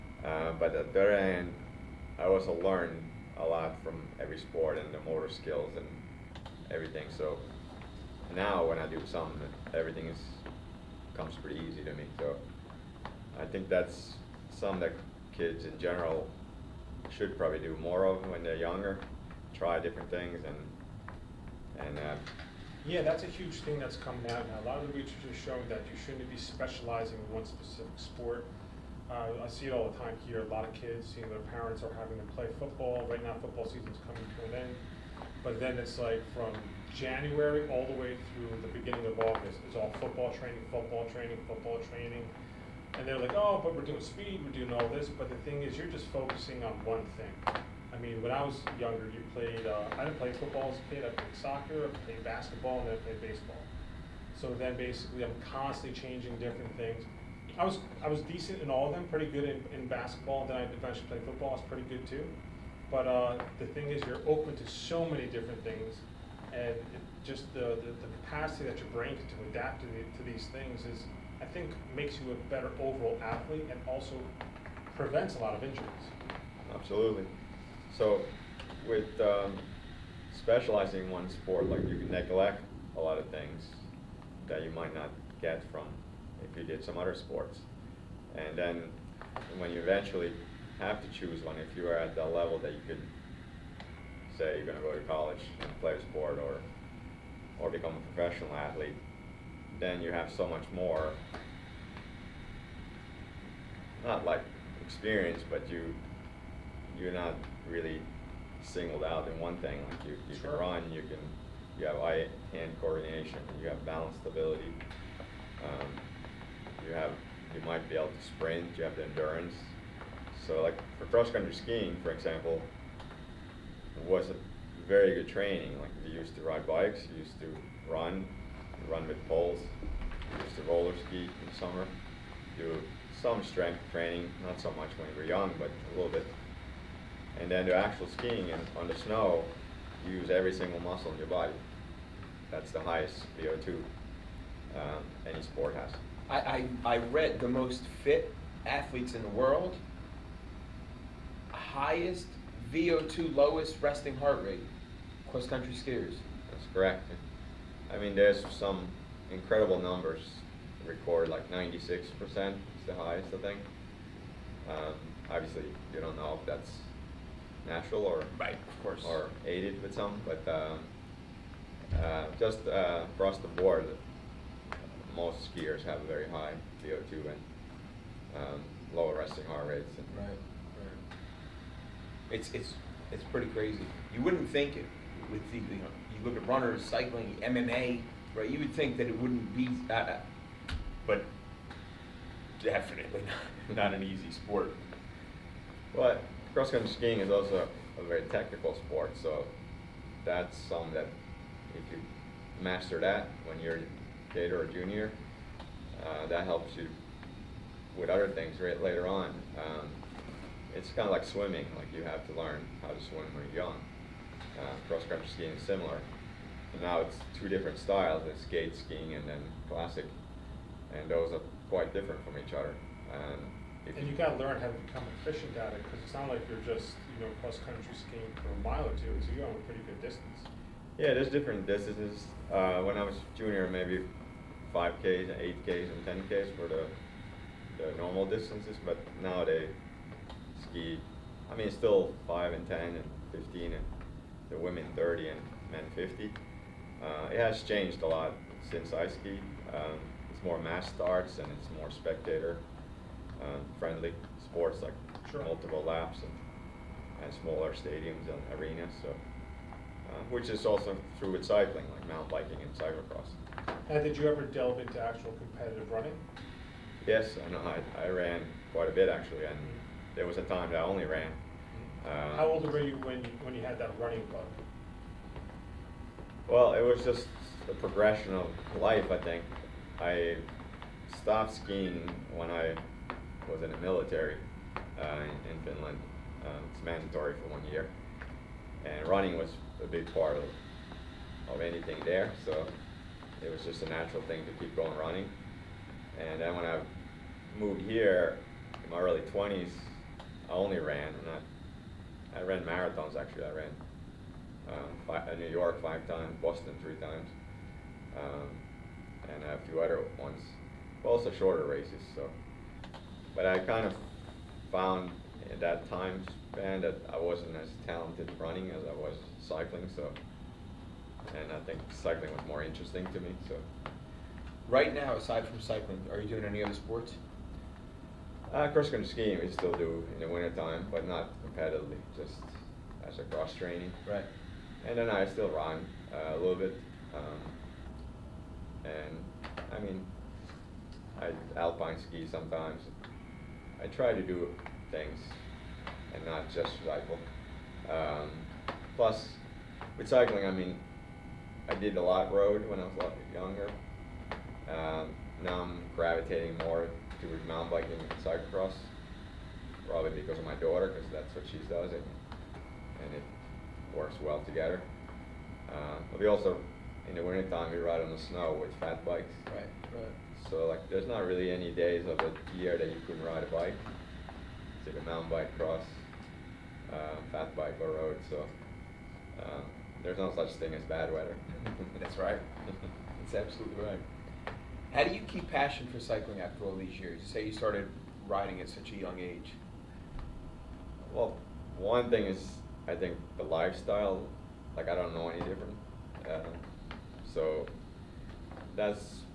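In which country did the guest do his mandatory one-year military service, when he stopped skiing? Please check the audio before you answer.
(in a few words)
Finland.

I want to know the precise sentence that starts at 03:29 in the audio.
Um, it's kind of like swimming, like you have to learn how to swim when you're young.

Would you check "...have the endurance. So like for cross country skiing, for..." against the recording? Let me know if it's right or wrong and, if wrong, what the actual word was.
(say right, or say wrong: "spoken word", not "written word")
right.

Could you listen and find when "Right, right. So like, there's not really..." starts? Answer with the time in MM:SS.
06:09.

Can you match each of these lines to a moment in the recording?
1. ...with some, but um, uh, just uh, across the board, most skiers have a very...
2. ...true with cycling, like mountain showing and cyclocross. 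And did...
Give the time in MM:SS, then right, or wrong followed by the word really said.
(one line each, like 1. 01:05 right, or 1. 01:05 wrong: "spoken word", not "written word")
1. 02:49 right
2. 04:21 wrong: "biking", not "showing".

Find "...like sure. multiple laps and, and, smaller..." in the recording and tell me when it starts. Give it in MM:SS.
04:14.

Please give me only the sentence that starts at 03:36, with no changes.
And now it's two different styles, it's skate skiing and then classic, and those are quite different from each other.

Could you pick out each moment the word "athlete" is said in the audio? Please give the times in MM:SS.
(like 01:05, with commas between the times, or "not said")
01:13, 01:38, 02:28.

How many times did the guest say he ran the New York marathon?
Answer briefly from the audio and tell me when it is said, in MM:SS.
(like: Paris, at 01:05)
5, at 05:05.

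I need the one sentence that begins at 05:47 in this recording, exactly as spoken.
Um, plus, recycling, I mean, I did a lot of road when I was a lot younger.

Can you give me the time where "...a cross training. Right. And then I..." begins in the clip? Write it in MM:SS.
05:33.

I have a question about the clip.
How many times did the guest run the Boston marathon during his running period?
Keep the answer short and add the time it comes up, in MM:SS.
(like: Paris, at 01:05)
3, at 05:06.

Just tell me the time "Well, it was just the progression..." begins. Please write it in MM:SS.
04:36.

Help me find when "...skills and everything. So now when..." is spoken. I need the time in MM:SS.
00:05.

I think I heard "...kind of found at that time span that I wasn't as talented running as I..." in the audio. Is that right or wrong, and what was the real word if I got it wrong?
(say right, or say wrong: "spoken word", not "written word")
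right.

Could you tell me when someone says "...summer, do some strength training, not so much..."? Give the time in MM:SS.
02:11.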